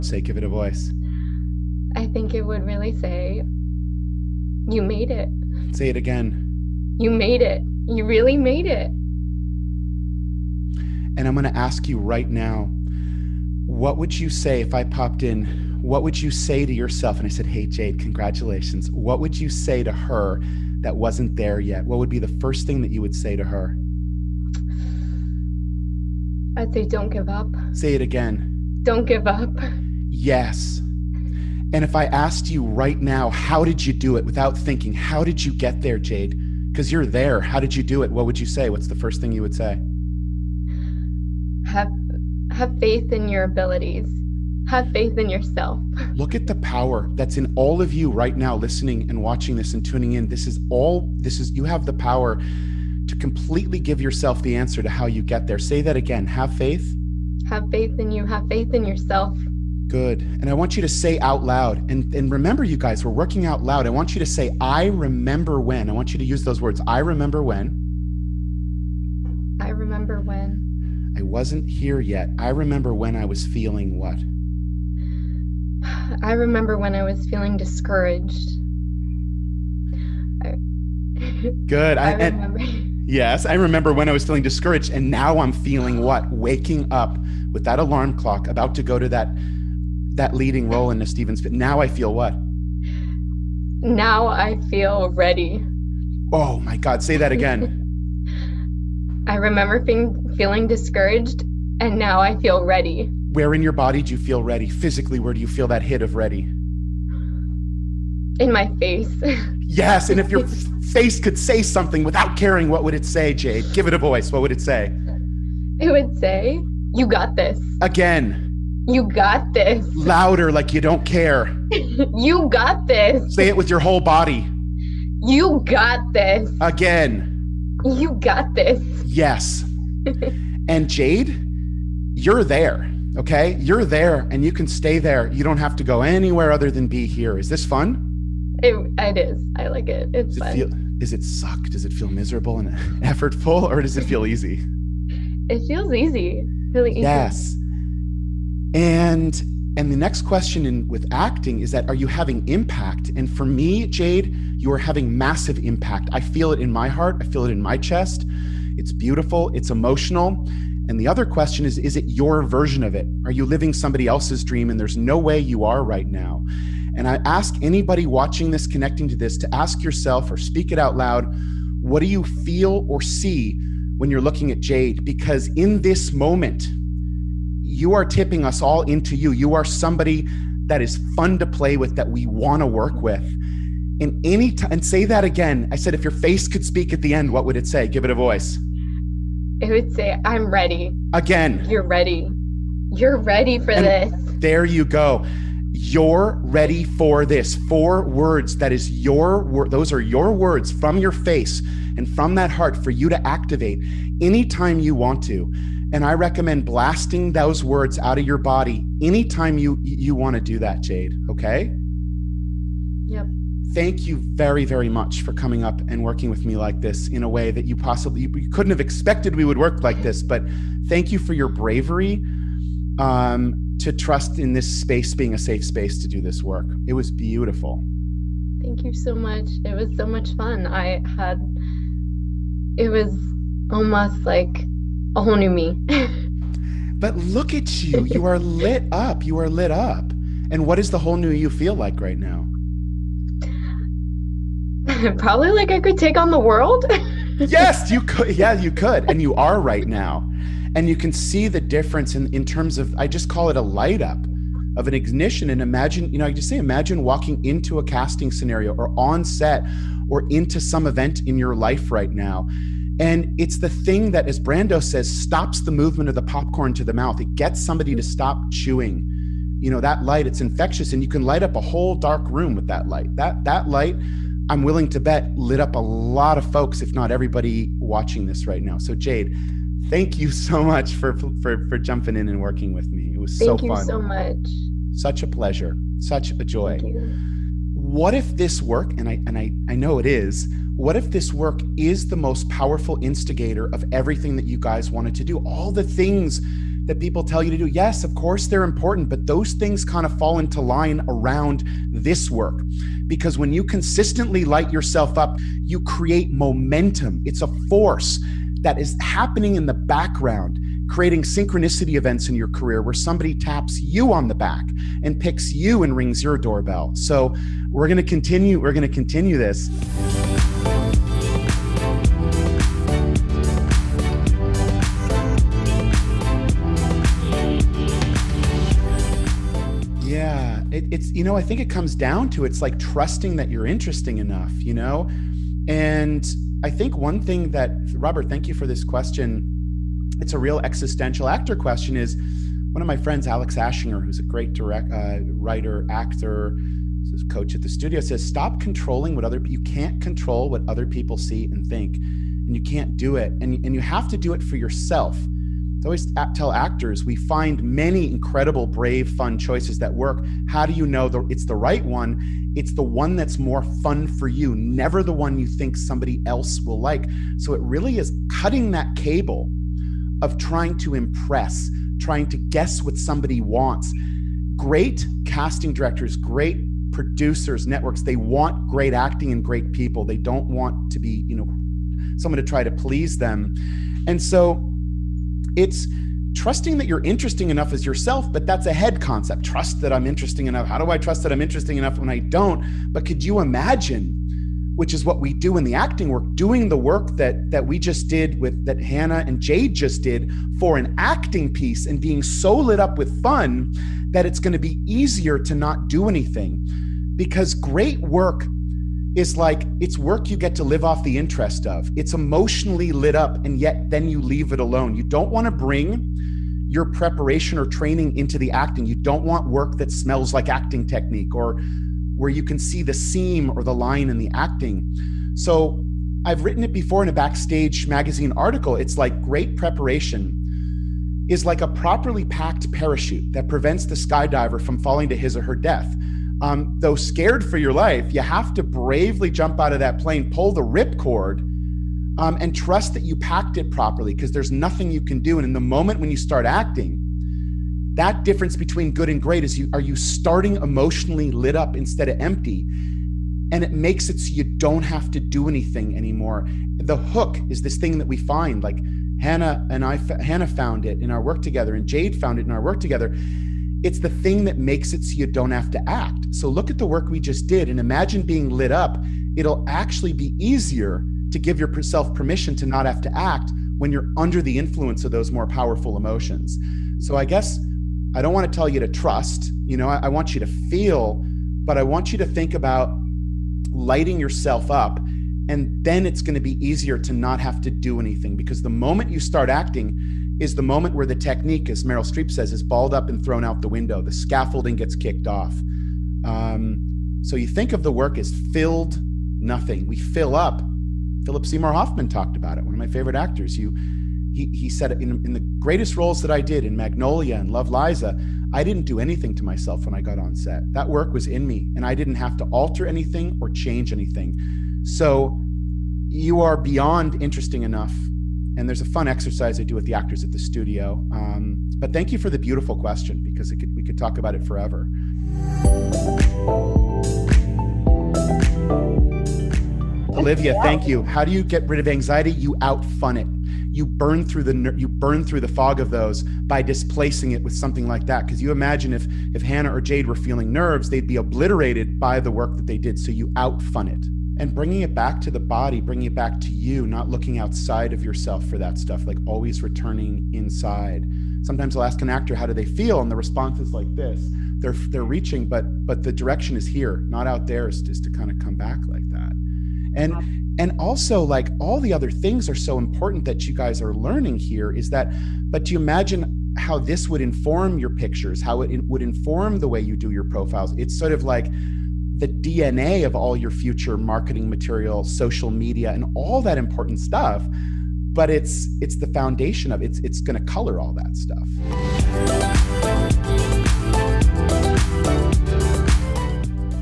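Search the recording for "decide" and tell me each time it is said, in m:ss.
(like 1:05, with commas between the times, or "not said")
not said.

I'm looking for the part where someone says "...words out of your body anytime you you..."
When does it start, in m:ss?
3:27.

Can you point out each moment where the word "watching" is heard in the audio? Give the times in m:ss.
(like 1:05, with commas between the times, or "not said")
0:49, 2:48, 4:37.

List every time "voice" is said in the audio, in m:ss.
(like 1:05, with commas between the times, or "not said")
0:00, 1:53, 3:08.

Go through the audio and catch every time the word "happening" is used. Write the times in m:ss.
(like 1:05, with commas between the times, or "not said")
5:08.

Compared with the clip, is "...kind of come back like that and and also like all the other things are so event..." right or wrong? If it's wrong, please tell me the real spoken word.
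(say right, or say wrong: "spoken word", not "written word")
wrong: "important", not "event".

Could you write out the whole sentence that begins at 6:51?
It's emotionally lit up, and yet then you leave it alone.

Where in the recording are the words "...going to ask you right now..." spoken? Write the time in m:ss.
0:11.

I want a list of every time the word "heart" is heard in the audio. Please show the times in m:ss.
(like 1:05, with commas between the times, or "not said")
2:36, 3:22.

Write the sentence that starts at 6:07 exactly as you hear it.
So it really is cutting that cable of trying to impress, trying to guess what somebody wants.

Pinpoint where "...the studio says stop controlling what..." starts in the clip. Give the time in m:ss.
5:47.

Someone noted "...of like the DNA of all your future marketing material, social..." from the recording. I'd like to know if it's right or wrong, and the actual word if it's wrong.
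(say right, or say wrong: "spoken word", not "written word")
right.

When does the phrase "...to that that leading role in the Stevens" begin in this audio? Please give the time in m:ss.
1:28.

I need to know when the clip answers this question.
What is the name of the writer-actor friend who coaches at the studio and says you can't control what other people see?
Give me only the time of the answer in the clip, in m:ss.
5:43.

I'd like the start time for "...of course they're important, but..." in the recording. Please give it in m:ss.
4:58.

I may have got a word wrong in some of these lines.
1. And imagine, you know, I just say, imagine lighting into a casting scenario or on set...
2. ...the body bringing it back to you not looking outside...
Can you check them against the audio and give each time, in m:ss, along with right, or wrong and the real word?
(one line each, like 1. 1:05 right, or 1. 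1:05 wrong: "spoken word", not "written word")
1. 4:15 wrong: "walking", not "lighting"
2. 9:05 right.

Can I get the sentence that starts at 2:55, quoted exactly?
Because in this moment, you are tipping us all into you.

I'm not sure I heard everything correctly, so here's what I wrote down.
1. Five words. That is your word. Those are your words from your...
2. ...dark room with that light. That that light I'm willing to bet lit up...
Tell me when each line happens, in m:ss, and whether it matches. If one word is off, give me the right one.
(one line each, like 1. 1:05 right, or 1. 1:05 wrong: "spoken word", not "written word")
1. 3:17 wrong: "Four", not "Five"
2. 4:31 right.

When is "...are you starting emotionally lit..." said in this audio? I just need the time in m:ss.
7:29.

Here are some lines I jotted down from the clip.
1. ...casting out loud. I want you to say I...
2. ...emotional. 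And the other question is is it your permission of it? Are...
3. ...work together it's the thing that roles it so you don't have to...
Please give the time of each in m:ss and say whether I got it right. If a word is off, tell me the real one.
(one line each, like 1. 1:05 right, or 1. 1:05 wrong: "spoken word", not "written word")
1. 1:03 wrong: "working", not "casting"
2. 2:39 wrong: "version", not "permission"
3. 7:42 wrong: "makes", not "roles".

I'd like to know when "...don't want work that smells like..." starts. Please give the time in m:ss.
6:58.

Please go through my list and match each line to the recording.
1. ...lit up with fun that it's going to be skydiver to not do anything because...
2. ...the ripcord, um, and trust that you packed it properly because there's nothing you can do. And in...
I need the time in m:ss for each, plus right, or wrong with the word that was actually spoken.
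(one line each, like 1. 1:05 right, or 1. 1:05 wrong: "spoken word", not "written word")
1. 6:42 wrong: "easier", not "skydiver"
2. 7:20 right.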